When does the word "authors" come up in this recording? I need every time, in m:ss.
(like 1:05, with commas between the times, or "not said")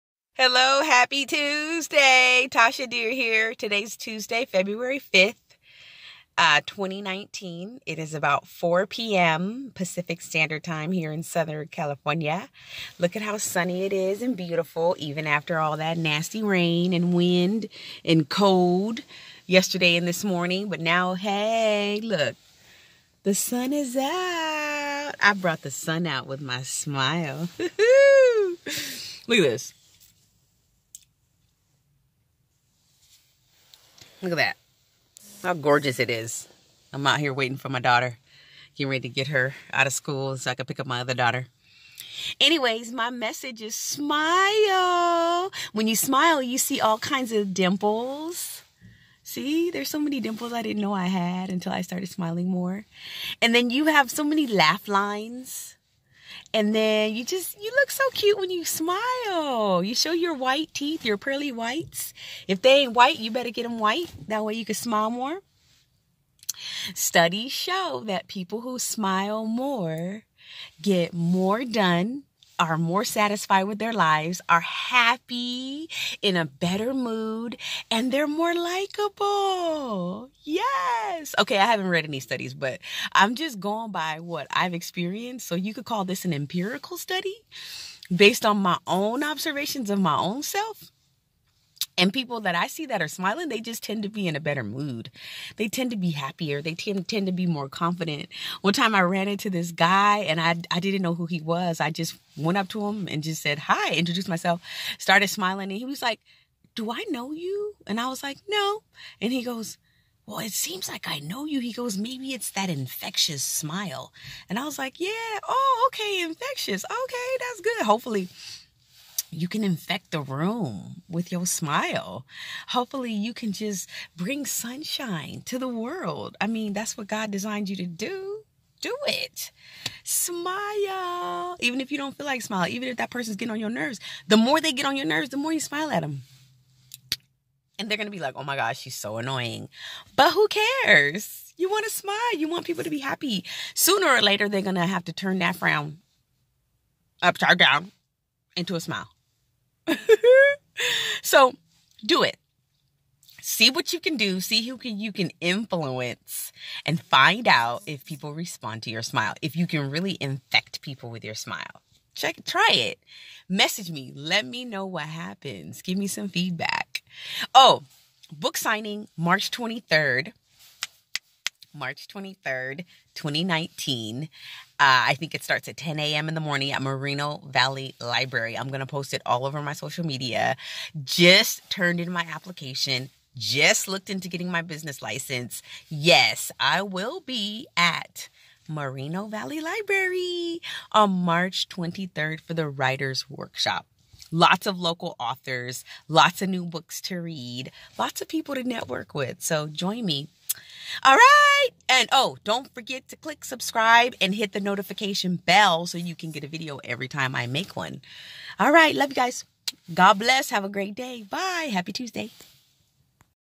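3:15.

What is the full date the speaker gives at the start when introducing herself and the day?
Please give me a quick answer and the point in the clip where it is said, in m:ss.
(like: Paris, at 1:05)
February 5th, 2019, at 0:04.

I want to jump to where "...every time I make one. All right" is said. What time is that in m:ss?
3:26.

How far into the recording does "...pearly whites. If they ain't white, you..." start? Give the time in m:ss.
1:01.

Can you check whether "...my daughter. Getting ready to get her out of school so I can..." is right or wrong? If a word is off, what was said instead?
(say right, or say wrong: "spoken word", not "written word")
right.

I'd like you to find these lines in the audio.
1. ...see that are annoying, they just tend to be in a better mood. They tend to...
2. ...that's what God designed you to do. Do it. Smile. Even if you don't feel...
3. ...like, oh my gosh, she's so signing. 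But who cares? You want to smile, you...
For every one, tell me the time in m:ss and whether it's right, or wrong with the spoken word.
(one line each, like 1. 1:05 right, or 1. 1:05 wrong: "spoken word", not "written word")
1. 1:32 wrong: "smiling", not "annoying"
2. 2:06 right
3. 2:18 wrong: "annoying", not "signing".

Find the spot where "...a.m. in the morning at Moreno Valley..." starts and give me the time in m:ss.
2:55.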